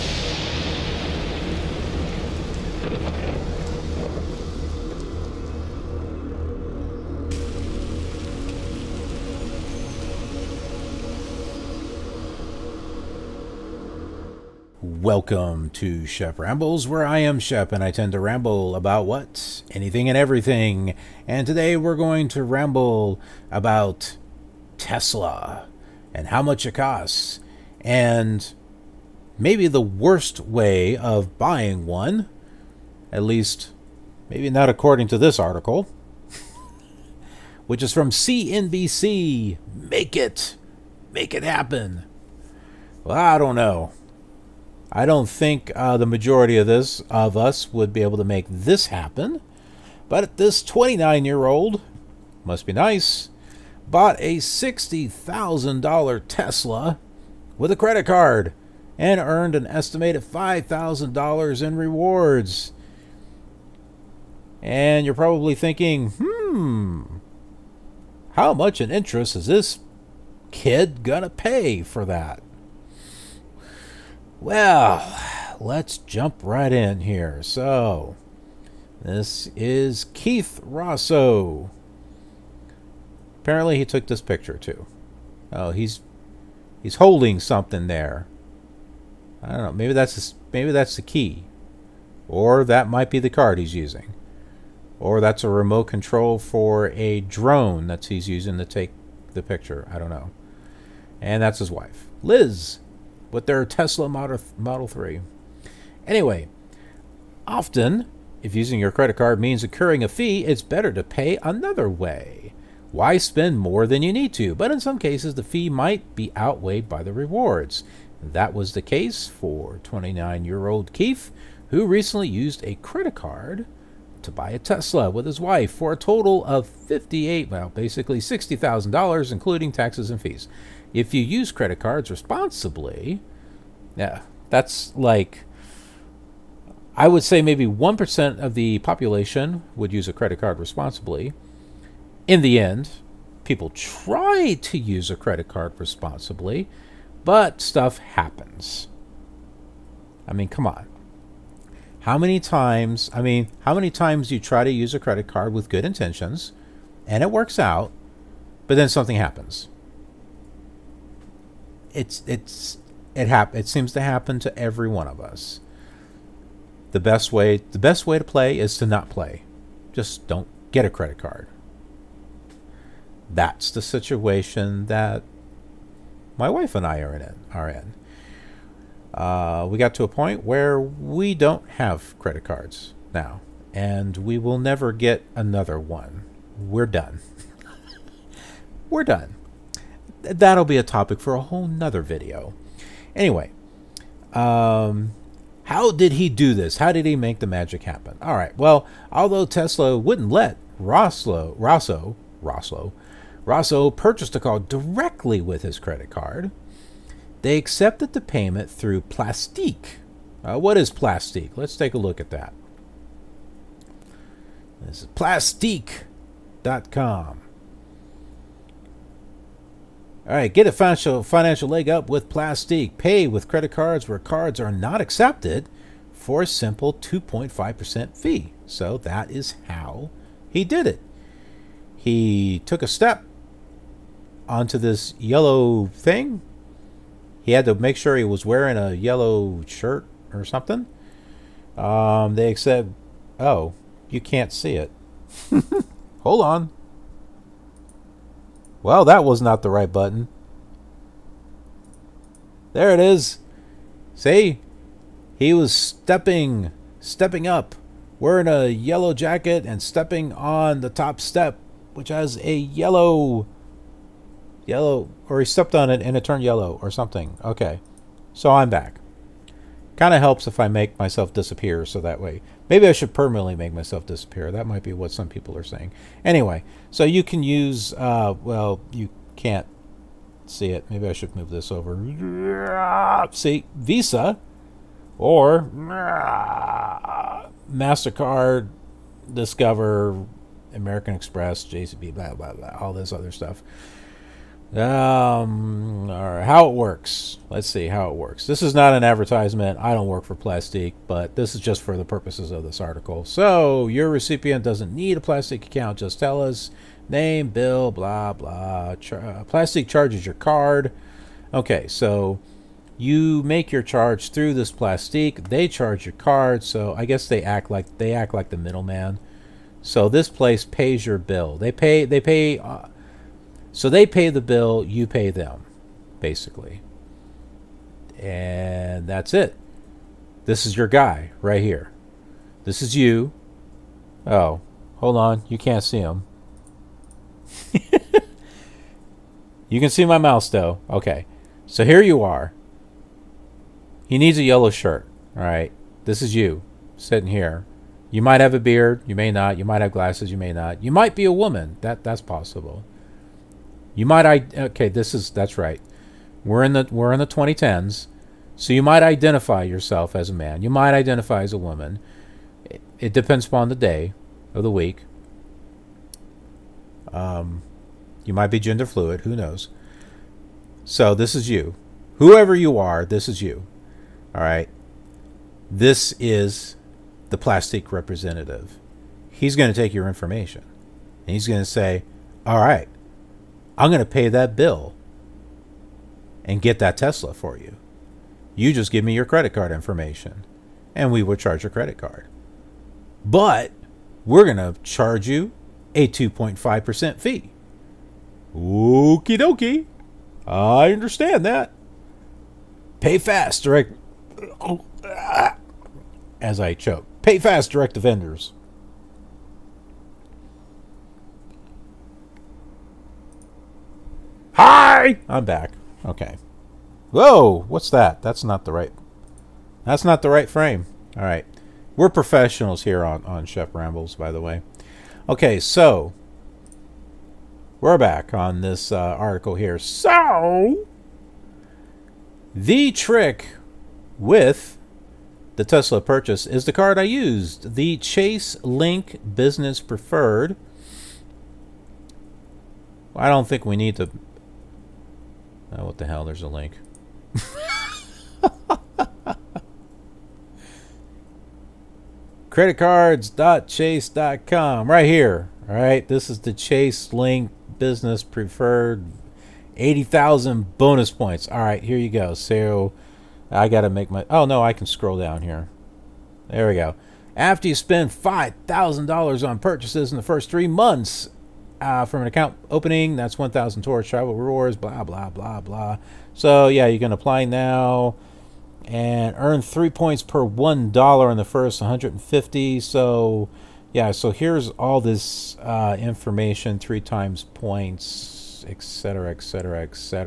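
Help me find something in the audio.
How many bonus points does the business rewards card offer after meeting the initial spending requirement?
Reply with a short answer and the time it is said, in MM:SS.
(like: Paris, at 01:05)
80,000, at 07:39.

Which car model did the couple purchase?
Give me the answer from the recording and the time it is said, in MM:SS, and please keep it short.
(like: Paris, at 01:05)
Model Three, at 01:44.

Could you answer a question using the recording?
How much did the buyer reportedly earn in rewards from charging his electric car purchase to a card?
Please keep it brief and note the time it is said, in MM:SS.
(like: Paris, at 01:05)
$5,000, at 01:00.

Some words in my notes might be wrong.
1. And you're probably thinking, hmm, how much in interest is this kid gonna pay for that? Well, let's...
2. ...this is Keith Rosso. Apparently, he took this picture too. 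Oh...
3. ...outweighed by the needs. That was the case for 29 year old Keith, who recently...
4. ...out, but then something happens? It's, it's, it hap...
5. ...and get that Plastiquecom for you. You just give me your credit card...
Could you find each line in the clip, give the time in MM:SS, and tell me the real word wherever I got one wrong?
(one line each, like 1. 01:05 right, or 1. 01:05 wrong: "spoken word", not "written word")
1. 01:04 right
2. 01:19 right
3. 01:56 wrong: "rewards", not "needs"
4. 02:37 right
5. 06:26 wrong: "Tesla", not "Plastiquecom".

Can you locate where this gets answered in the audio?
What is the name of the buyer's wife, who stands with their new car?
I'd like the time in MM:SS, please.
01:42.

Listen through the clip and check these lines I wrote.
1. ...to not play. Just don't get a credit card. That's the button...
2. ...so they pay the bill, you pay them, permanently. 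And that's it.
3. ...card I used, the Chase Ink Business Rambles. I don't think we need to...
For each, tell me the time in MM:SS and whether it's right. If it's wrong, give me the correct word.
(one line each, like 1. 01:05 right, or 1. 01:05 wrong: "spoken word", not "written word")
1. 02:48 wrong: "situation", not "button"
2. 05:23 wrong: "basically", not "permanently"
3. 07:16 wrong: "Preferred", not "Rambles".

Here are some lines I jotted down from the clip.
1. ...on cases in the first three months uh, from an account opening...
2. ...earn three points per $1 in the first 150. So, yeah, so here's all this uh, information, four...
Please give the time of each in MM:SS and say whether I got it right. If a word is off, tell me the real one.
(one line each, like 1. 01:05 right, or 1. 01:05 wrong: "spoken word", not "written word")
1. 07:49 wrong: "purchases", not "cases"
2. 07:59 wrong: "three", not "four".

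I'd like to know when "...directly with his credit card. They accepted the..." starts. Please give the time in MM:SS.
03:24.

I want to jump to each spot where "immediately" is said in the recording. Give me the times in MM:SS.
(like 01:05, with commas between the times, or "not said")
not said.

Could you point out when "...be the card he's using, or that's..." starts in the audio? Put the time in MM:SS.
01:33.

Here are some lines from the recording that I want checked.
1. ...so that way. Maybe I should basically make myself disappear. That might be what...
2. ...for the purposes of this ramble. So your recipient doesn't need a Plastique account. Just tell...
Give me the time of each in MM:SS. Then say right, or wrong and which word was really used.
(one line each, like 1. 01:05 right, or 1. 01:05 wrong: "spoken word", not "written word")
1. 04:31 wrong: "permanently", not "basically"
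2. 05:01 wrong: "article", not "ramble".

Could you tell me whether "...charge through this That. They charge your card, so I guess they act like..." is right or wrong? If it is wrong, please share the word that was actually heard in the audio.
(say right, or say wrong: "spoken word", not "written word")
wrong: "Plastique", not "That".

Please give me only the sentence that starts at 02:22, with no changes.
In the end, people try to use a credit card responsibly.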